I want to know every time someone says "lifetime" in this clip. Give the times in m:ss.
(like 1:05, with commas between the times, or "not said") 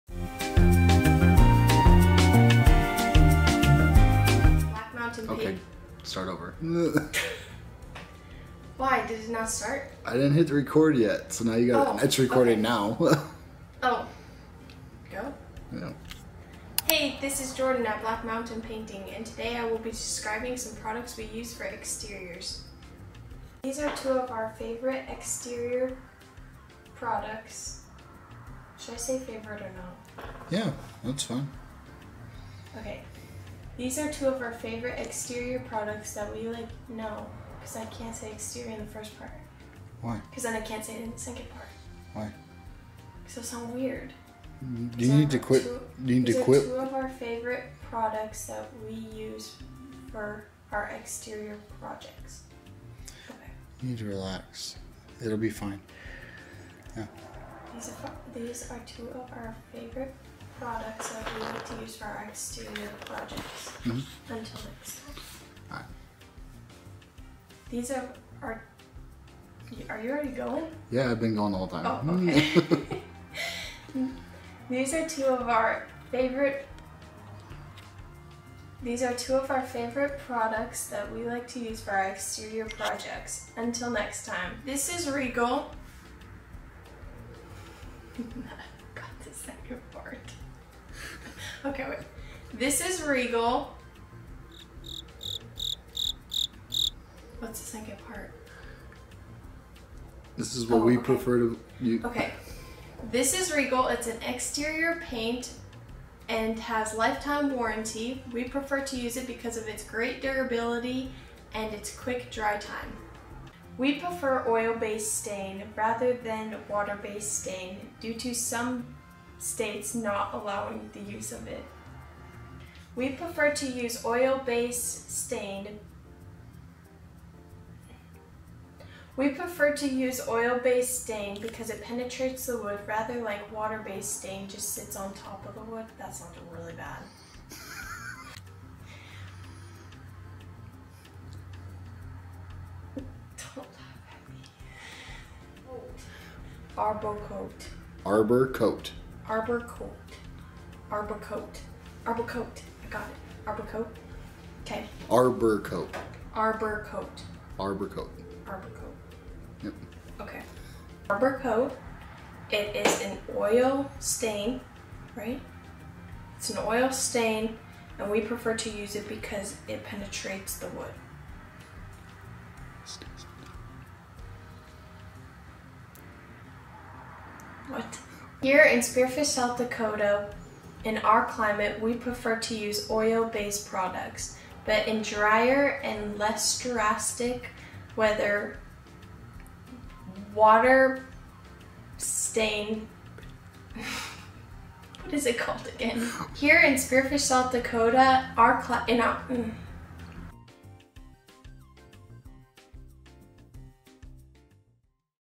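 1:46.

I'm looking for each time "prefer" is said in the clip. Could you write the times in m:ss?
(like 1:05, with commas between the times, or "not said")
1:41, 1:48, 1:53, 2:03, 2:09, 2:48, 3:01.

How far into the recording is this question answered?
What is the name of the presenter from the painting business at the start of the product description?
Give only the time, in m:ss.
0:17.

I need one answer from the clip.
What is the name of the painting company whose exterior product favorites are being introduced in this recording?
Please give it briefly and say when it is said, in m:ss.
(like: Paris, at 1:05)
Black Mountain Painting, at 0:18.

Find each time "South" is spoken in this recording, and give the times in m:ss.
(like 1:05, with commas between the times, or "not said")
2:59, 3:17.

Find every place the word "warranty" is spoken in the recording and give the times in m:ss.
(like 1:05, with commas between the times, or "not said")
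1:47.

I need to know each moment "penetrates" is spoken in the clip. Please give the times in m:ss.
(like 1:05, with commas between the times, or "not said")
2:11, 2:49.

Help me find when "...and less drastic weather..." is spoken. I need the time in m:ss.
3:05.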